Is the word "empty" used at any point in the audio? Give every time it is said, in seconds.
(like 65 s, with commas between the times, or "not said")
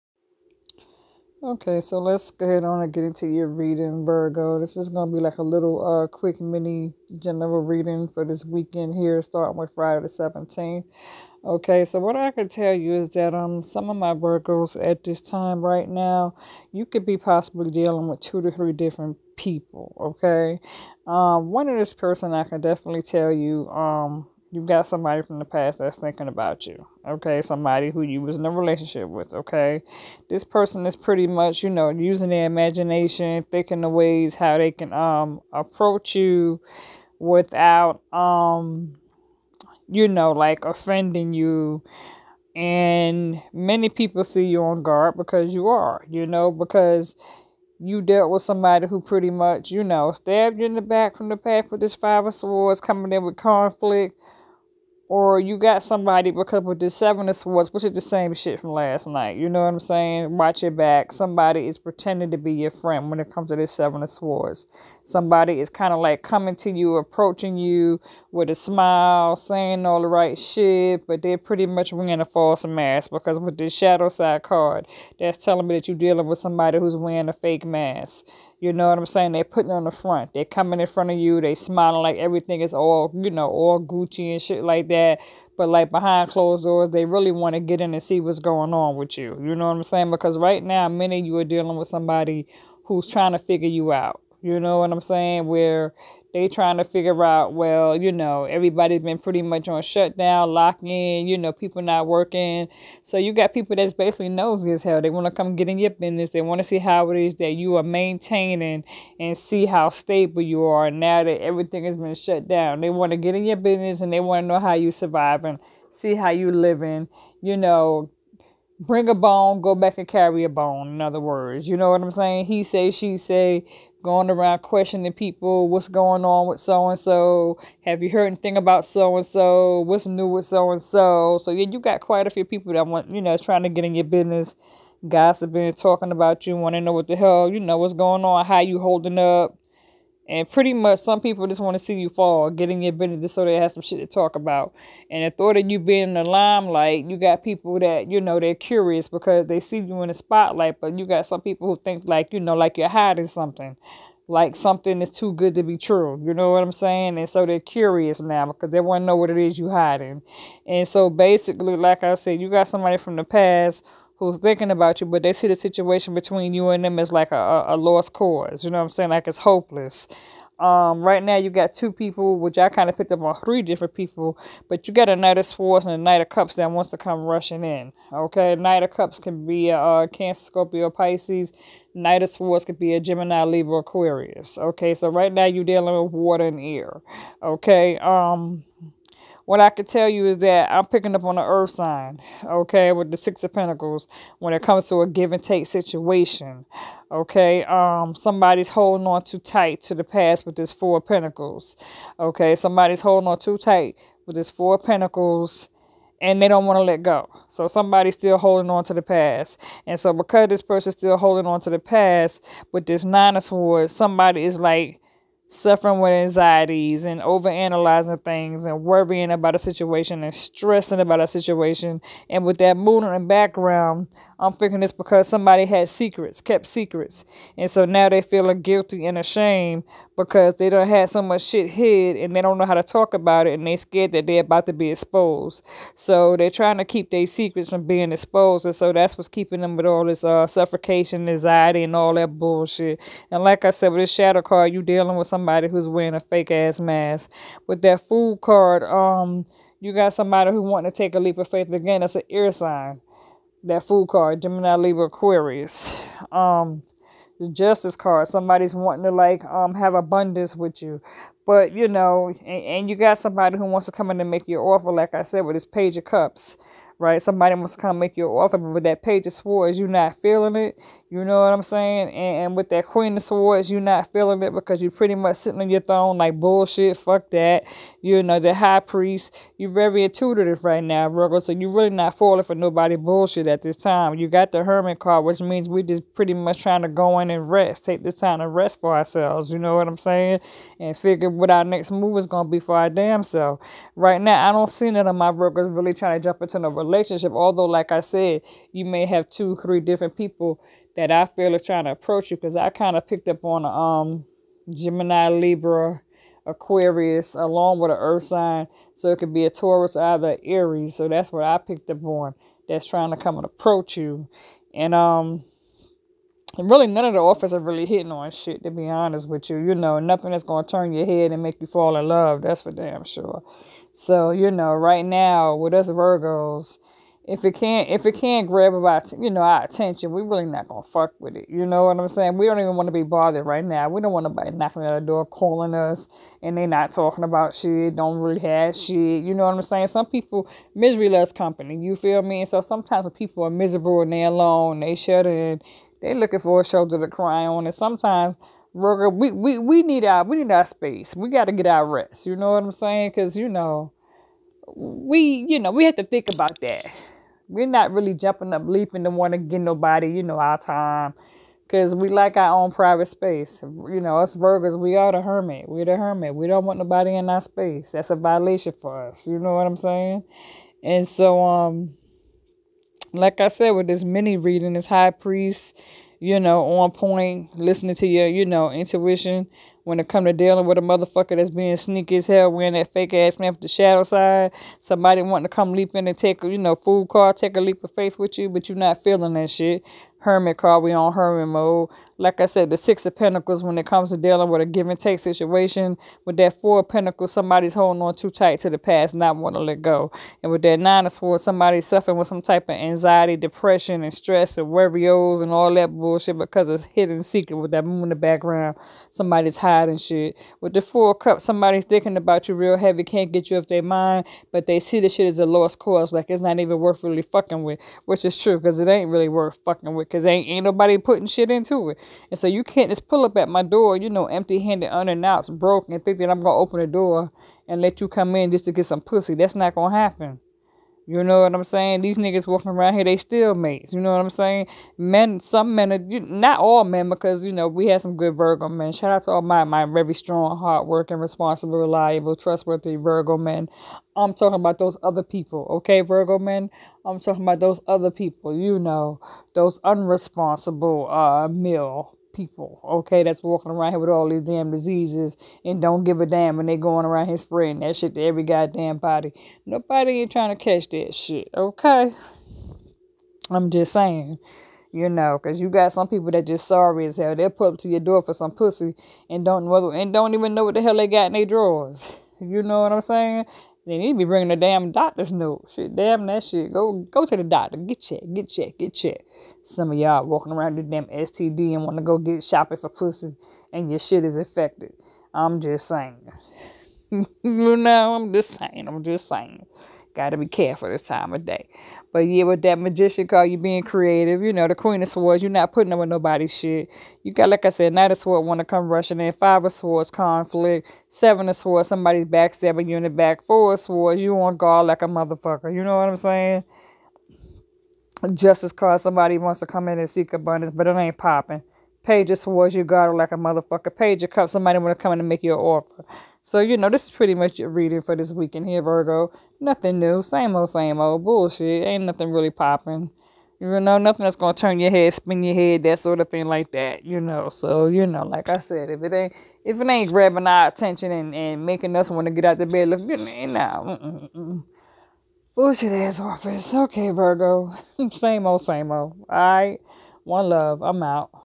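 424 s.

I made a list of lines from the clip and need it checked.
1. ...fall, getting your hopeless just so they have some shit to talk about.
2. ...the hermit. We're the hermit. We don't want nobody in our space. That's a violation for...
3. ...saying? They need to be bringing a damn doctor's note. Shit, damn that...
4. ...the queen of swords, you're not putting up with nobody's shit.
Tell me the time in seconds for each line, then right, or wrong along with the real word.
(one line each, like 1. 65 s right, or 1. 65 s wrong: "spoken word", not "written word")
1. 142 s wrong: "business", not "hopeless"
2. 365 s right
3. 473 s right
4. 494 s right.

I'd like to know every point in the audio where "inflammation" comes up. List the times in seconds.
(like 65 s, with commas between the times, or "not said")
not said.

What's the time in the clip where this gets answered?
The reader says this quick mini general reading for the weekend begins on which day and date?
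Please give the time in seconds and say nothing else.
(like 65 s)
9 s.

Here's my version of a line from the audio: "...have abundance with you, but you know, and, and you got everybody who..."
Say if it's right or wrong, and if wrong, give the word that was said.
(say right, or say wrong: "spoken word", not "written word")
wrong: "somebody", not "everybody".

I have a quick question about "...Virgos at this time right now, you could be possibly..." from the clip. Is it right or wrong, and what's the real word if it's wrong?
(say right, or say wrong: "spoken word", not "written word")
right.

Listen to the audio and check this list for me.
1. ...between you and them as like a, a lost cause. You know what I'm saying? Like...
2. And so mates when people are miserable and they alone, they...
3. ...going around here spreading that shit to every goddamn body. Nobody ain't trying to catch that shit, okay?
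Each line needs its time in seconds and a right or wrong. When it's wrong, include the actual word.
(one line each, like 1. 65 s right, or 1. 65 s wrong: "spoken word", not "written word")
1. 166 s right
2. 342 s wrong: "sometimes", not "mates"
3. 456 s right.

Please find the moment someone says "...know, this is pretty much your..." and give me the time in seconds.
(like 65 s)
516 s.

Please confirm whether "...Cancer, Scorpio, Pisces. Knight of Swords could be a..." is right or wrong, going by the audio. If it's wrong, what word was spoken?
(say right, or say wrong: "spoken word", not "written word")
right.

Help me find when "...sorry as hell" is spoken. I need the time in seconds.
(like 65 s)
466 s.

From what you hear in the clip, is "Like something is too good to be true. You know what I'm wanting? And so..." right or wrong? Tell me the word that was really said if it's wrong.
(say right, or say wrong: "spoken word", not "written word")
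wrong: "saying", not "wanting".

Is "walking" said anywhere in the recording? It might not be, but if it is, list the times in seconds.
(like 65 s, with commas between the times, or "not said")
432 s, 453 s, 480 s.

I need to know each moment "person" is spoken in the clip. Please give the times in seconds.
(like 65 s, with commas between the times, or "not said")
21 s, 30 s, 210 s.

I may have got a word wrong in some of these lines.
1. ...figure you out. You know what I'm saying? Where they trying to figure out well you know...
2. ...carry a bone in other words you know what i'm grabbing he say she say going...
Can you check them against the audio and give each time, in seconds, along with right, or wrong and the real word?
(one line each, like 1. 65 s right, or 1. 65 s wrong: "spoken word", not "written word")
1. 93 s right
2. 120 s wrong: "saying", not "grabbing".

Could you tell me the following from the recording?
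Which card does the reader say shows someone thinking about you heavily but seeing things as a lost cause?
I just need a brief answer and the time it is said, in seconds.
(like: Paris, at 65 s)
Four of Cups, at 410 s.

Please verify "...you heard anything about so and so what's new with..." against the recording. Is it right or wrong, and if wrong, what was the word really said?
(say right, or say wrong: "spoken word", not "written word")
right.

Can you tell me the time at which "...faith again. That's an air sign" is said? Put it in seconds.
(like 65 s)
251 s.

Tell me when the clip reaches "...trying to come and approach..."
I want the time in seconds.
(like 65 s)
312 s.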